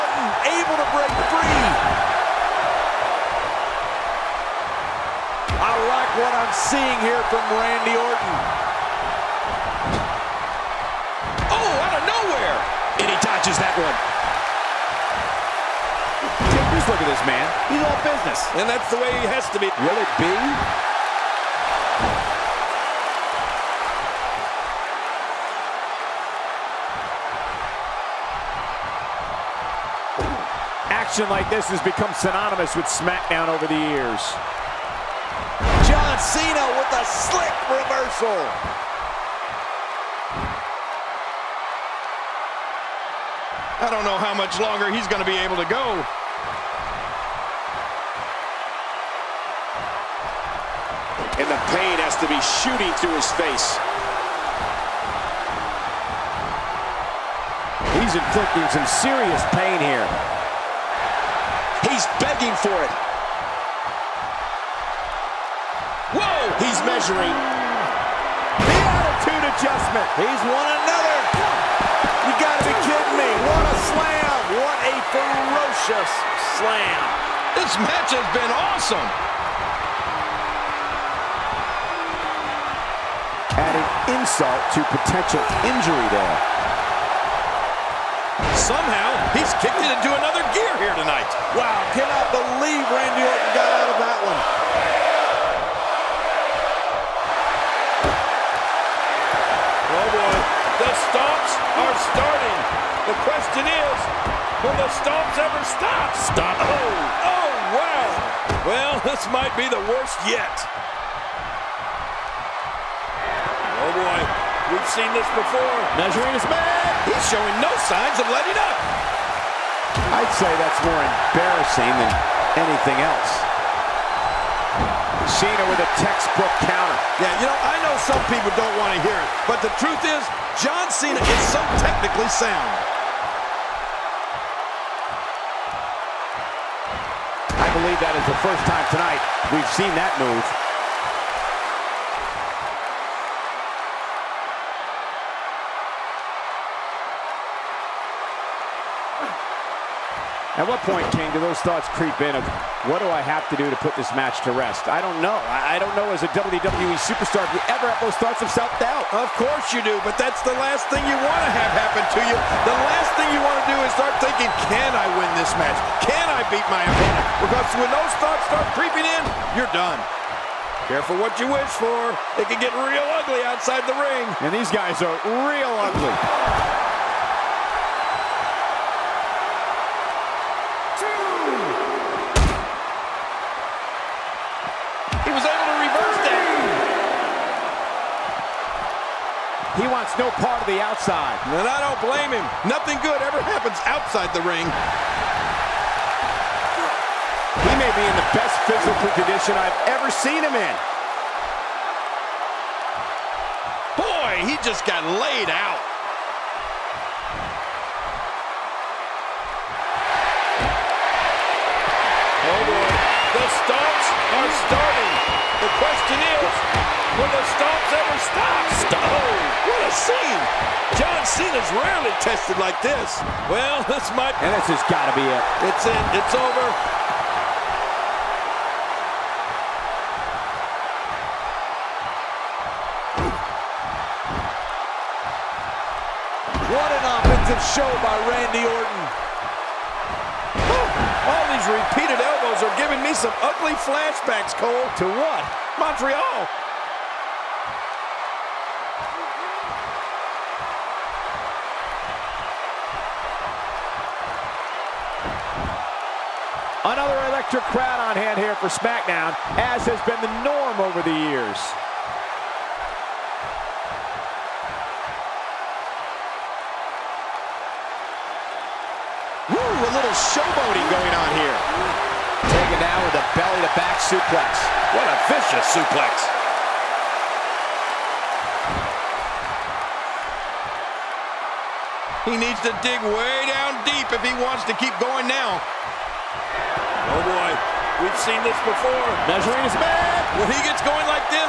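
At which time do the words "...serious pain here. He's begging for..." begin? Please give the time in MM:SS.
00:58.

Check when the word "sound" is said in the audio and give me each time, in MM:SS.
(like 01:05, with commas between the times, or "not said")
02:12.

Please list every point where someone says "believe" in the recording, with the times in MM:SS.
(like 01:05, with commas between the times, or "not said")
01:32, 02:17.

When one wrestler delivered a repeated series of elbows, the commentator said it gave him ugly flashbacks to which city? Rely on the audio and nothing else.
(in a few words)
Montreal.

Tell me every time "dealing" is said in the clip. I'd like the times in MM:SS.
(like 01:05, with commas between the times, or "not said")
not said.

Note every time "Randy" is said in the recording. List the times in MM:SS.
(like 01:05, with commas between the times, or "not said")
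00:07, 01:32, 03:58.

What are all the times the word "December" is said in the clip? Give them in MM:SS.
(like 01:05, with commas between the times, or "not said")
not said.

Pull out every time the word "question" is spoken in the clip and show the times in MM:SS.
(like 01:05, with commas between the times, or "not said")
01:43, 03:35.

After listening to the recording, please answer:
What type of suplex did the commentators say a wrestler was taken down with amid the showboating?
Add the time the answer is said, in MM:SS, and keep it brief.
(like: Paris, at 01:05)
Belly-to-back, at 04:33.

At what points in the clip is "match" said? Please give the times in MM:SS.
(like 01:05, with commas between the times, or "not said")
01:17, 02:34, 02:45.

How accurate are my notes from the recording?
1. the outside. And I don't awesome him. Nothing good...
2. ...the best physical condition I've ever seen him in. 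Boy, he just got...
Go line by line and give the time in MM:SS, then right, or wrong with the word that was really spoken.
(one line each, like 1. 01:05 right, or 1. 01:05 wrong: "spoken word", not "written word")
1. 03:10 wrong: "blame", not "awesome"
2. 03:18 right.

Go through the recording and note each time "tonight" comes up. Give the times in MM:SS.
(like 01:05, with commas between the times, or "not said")
01:30, 02:18.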